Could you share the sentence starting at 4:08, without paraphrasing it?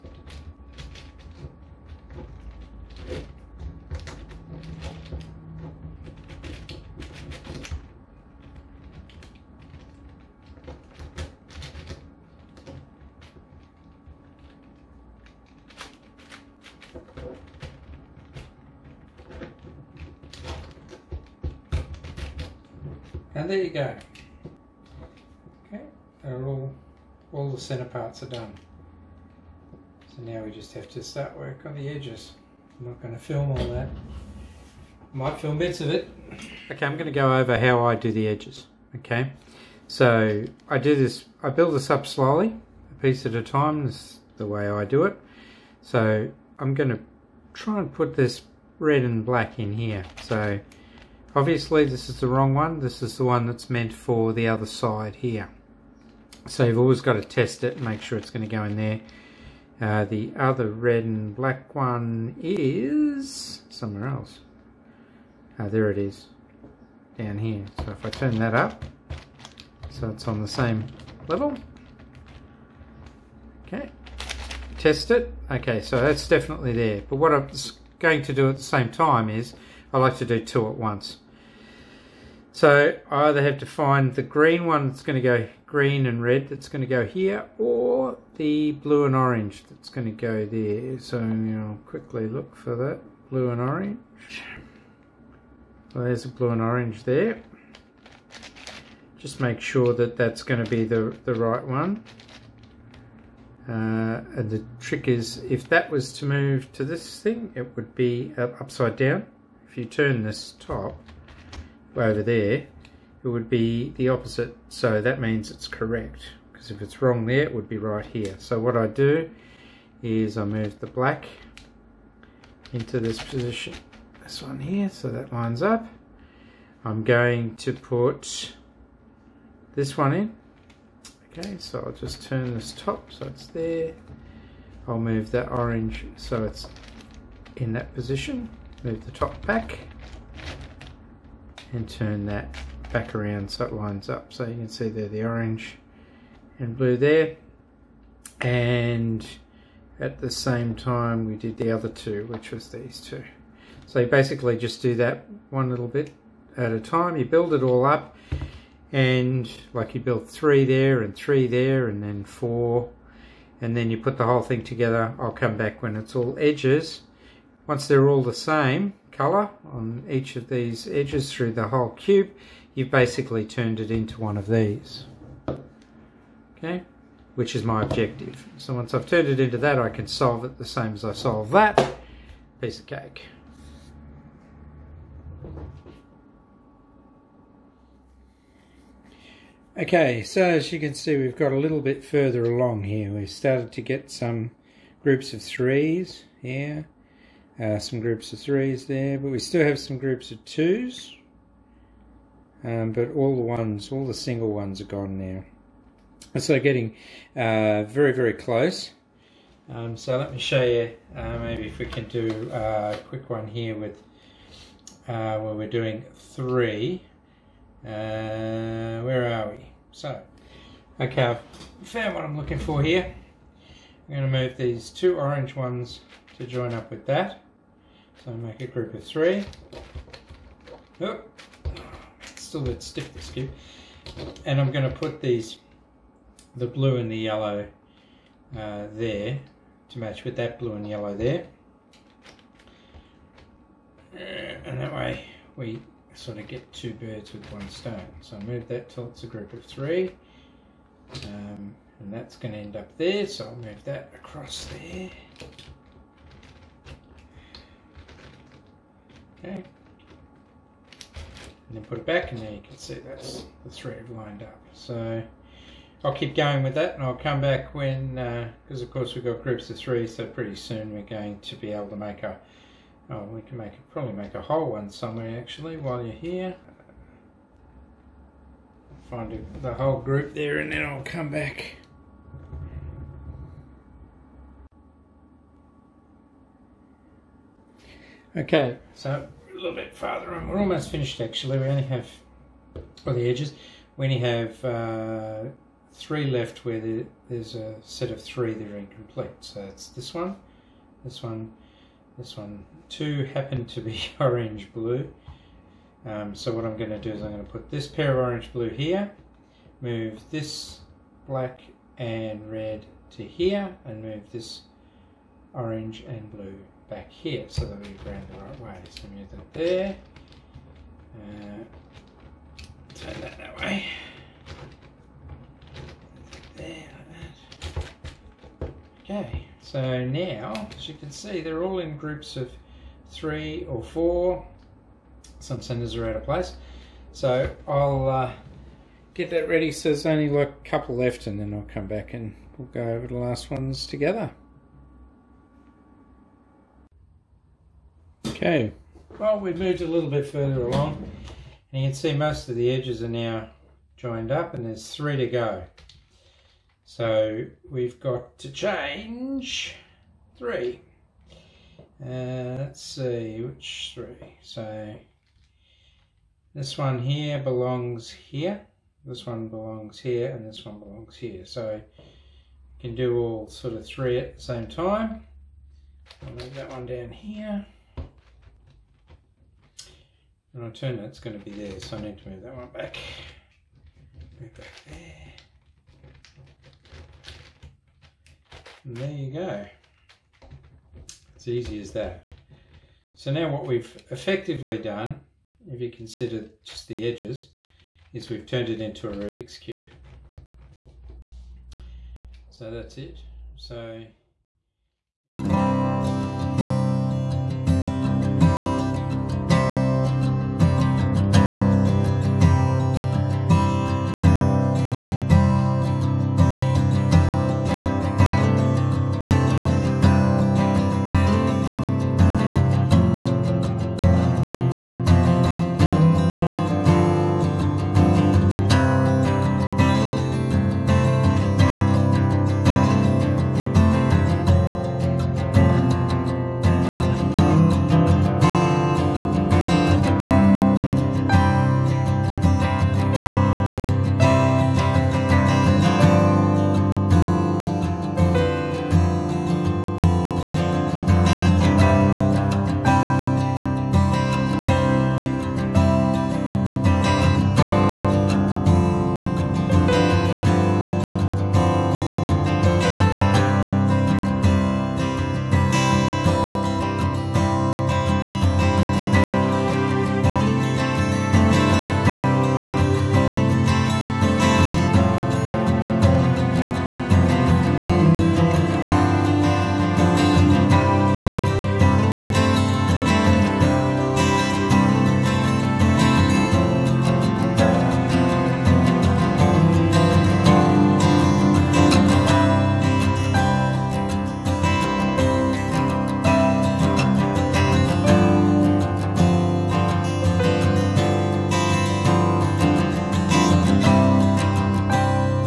So I move that till it's a group of three.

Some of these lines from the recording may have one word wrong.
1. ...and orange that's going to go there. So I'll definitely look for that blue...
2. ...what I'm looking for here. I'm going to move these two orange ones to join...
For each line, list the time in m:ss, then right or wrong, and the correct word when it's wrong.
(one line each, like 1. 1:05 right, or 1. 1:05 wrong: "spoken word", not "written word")
1. 1:29 wrong: "quickly", not "definitely"
2. 3:42 right.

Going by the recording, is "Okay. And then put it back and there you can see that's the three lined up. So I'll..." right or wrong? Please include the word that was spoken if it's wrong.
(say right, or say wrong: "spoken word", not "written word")
right.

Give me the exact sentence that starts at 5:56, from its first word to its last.
So we've got to change three.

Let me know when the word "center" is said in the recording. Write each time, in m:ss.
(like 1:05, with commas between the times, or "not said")
0:27, 5:35.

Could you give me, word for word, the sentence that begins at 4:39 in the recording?
Find the whole group there and then I'll come back.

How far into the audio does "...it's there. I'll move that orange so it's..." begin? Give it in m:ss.
2:13.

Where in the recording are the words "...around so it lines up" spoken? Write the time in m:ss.
2:23.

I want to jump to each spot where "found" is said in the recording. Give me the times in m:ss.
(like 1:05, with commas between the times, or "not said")
3:41.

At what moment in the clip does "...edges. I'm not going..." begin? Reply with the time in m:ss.
0:31.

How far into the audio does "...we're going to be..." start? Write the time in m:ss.
4:30.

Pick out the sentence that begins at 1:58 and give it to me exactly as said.
So what I do is I move the black into this position.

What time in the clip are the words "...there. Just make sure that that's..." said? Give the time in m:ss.
1:37.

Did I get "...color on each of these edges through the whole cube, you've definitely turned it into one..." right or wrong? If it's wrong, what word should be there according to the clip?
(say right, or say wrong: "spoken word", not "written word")
wrong: "basically", not "definitely".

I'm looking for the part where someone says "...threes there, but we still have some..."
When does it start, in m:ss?
3:18.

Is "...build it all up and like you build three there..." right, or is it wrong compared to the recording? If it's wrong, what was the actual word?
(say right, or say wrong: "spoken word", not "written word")
right.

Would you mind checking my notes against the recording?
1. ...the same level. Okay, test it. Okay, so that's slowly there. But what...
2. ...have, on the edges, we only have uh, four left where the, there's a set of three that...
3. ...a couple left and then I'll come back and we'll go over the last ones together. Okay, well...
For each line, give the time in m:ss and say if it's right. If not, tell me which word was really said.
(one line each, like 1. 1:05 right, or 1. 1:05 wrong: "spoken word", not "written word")
1. 1:10 wrong: "definitely", not "slowly"
2. 4:51 wrong: "three", not "four"
3. 5:40 right.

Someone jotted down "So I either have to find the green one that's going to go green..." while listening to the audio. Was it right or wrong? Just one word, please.
right.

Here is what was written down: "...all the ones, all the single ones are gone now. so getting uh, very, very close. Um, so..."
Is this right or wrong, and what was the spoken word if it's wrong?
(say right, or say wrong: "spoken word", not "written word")
right.